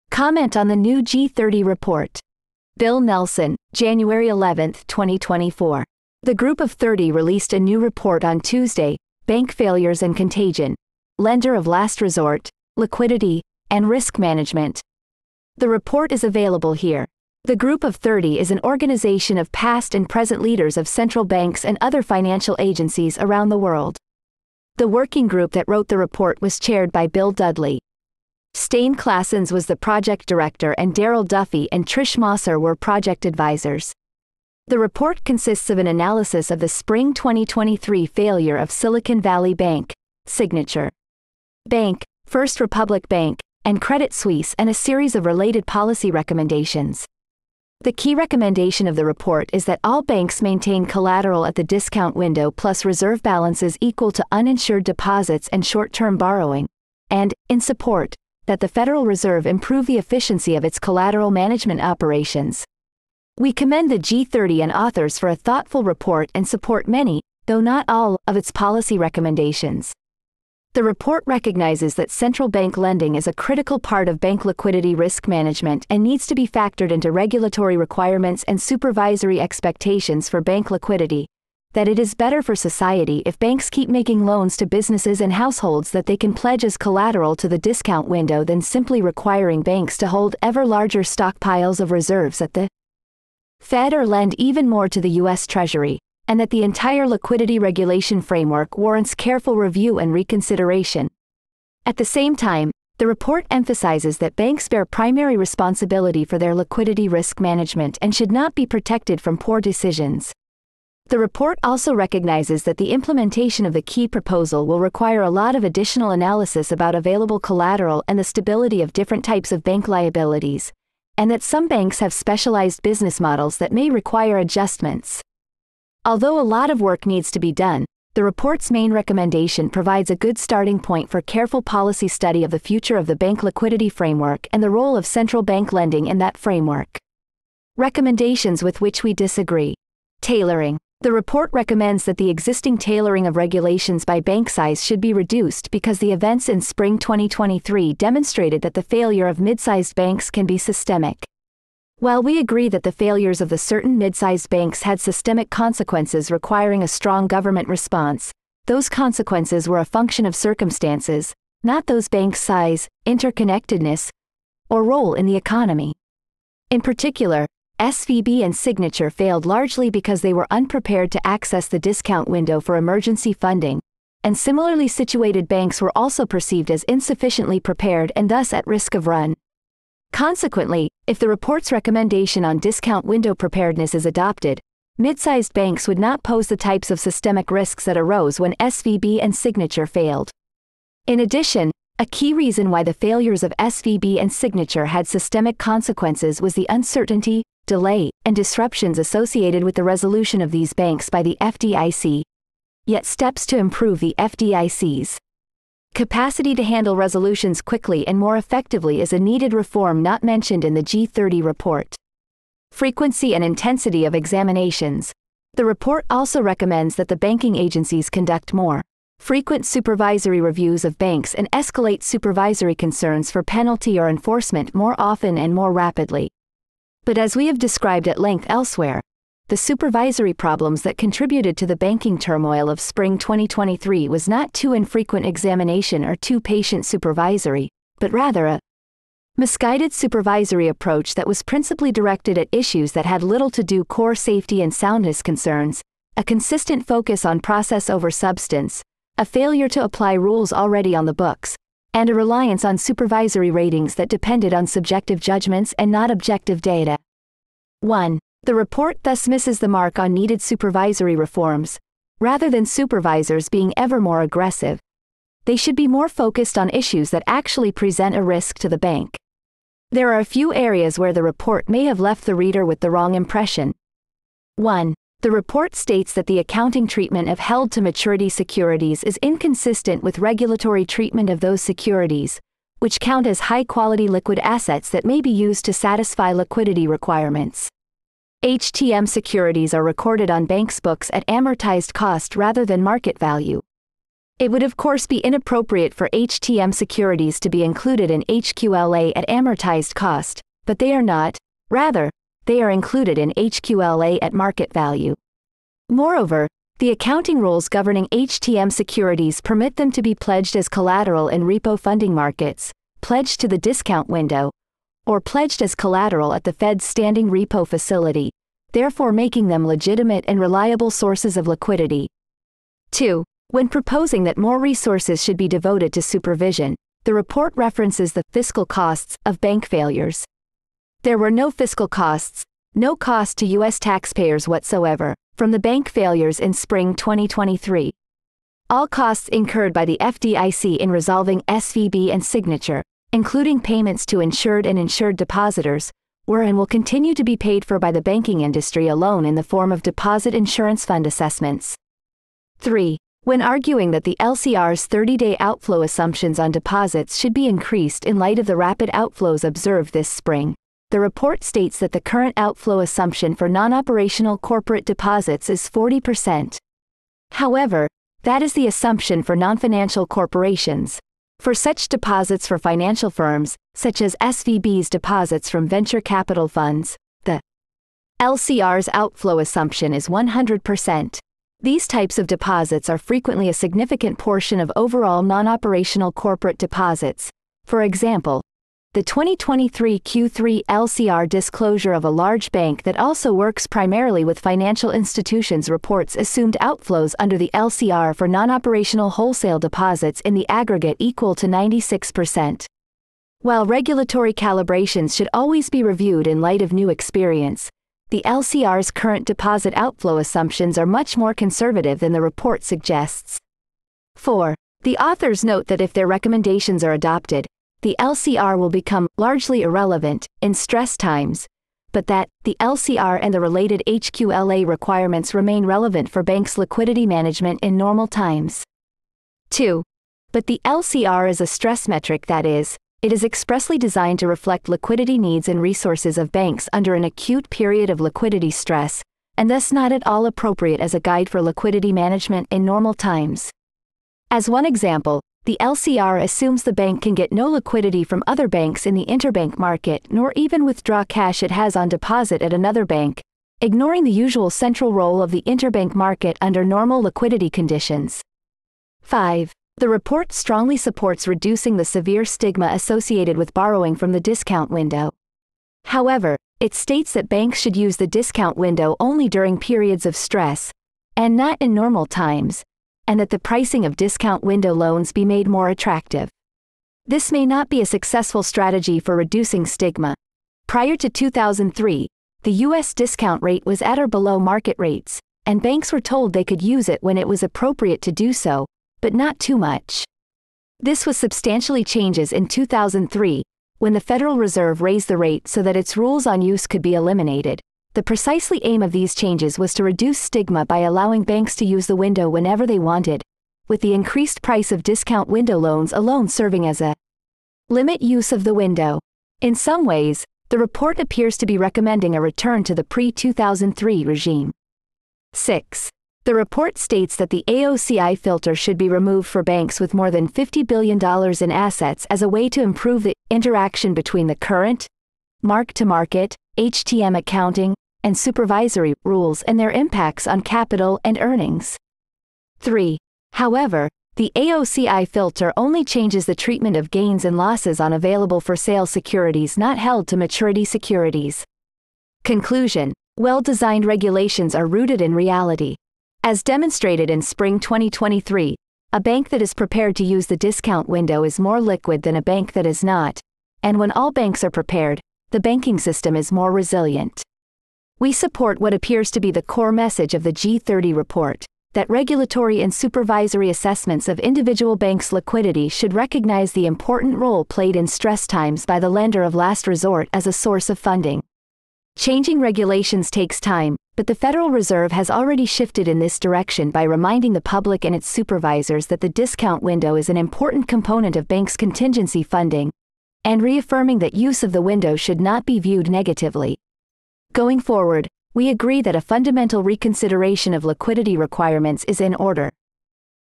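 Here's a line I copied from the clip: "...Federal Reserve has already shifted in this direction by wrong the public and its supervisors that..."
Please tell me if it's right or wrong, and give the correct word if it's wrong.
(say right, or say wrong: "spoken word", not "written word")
wrong: "reminding", not "wrong".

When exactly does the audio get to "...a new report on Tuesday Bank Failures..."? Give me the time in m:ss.
0:07.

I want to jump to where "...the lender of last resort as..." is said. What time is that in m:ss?
9:28.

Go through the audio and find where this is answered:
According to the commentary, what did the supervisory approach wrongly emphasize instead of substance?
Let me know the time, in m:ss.
4:07.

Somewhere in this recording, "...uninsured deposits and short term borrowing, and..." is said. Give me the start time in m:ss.
0:54.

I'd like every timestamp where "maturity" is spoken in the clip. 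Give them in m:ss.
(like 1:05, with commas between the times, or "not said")
4:37, 9:00.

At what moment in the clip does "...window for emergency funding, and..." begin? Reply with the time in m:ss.
2:52.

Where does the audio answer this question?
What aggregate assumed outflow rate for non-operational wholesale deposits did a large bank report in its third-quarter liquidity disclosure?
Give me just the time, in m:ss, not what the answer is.
6:41.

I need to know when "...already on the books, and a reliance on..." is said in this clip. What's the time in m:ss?
4:10.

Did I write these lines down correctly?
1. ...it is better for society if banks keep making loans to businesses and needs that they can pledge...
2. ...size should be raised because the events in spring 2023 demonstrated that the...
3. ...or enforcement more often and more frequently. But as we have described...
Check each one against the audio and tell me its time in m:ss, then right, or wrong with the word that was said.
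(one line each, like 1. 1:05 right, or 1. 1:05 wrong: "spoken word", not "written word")
1. 1:21 wrong: "households", not "needs"
2. 2:24 wrong: "reduced", not "raised"
3. 3:43 wrong: "rapidly", not "frequently".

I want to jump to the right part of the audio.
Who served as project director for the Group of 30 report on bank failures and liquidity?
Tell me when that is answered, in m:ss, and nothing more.
0:28.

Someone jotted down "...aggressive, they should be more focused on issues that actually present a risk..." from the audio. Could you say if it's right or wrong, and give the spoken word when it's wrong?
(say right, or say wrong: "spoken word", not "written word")
right.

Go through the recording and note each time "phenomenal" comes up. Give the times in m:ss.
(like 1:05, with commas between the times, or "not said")
not said.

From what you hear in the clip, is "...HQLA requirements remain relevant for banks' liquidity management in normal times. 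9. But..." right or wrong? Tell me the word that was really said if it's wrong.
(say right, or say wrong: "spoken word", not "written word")
wrong: "2", not "9".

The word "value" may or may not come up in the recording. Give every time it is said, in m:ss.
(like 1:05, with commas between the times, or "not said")
4:53, 5:04.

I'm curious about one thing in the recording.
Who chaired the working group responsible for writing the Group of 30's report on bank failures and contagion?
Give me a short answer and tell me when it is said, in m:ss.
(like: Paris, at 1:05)
Bill Dudley, at 0:27.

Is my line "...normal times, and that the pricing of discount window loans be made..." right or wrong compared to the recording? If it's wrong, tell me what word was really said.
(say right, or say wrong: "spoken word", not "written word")
right.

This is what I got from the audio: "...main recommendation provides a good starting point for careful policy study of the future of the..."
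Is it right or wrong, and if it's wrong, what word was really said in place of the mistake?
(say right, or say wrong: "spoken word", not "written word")
right.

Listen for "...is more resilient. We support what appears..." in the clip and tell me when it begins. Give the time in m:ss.
9:16.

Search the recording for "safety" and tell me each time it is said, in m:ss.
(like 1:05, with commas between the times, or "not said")
4:04.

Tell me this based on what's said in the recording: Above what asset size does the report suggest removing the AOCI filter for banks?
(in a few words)
$50 billion.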